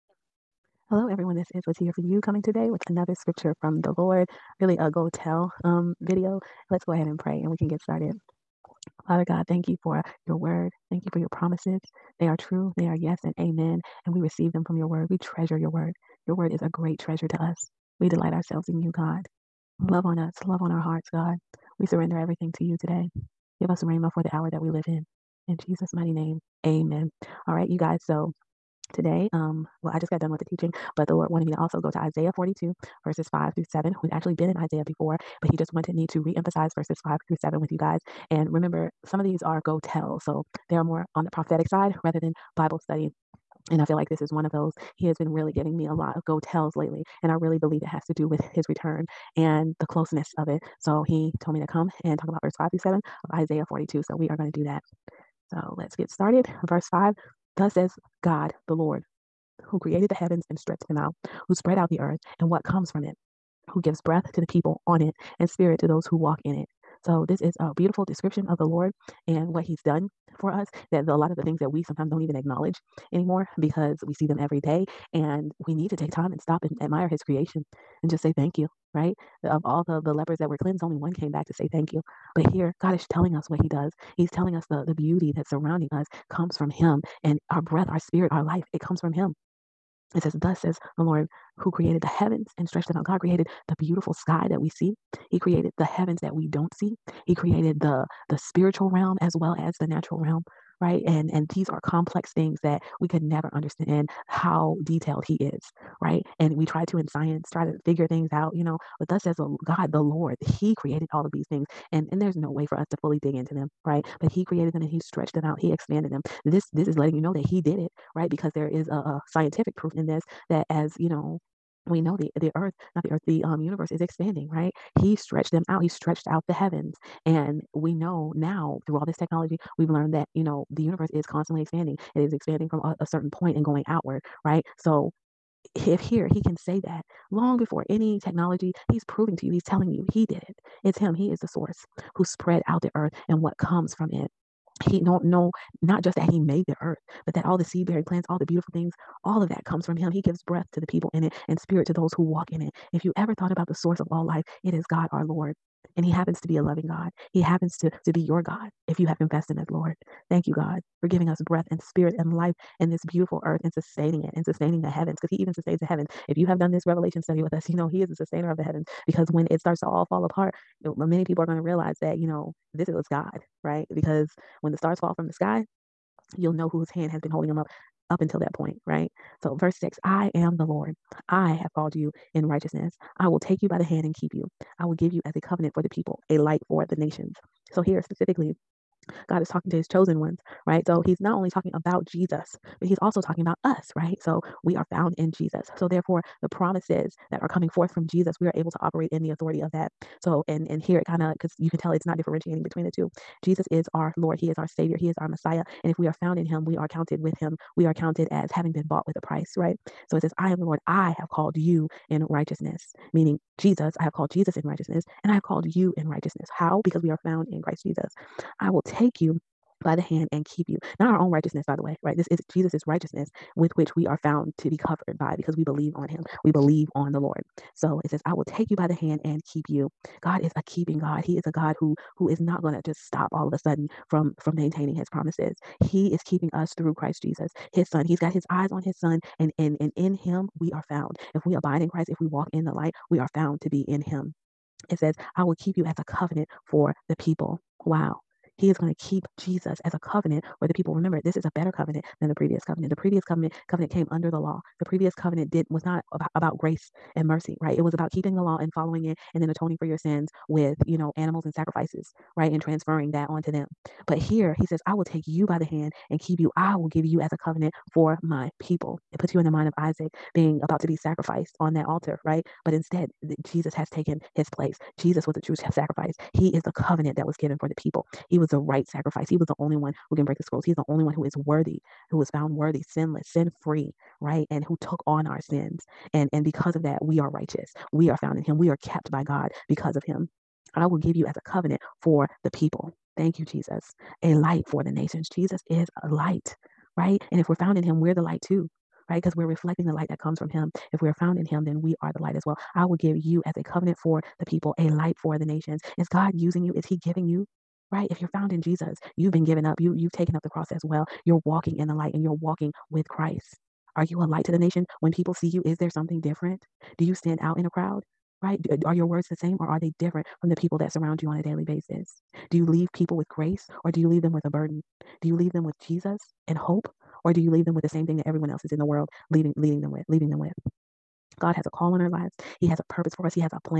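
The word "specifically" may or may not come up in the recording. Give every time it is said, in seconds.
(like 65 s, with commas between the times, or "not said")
188 s.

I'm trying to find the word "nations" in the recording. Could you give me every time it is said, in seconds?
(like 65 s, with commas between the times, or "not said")
186 s, 294 s, 305 s, 314 s.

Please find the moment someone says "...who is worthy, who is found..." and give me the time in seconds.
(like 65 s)
281 s.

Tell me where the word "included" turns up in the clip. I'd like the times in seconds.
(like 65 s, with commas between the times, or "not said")
not said.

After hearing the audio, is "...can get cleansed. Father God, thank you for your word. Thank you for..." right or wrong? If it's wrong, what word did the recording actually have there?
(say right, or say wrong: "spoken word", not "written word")
wrong: "started", not "cleansed".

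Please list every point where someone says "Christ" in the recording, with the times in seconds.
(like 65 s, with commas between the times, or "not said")
217 s, 236 s, 241 s, 313 s.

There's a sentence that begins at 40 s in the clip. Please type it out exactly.
So they are more on the prophetic side rather than Bible study.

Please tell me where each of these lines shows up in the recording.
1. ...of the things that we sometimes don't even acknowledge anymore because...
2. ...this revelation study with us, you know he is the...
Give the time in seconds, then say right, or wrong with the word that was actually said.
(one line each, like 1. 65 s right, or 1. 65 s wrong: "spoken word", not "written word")
1. 71 s right
2. 166 s right.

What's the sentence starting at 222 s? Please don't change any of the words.
This is Jesus's righteousness with which we are found to be covered by because we believe on him.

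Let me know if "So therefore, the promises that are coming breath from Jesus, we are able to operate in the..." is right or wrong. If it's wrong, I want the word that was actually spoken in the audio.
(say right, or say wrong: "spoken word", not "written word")
wrong: "forth", not "breath".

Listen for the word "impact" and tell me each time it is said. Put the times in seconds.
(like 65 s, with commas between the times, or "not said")
not said.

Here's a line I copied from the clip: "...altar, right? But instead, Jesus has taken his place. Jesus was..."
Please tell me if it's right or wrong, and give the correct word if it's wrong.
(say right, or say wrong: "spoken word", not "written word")
right.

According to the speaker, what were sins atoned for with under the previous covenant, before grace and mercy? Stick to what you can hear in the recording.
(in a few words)
Animals and sacrifices.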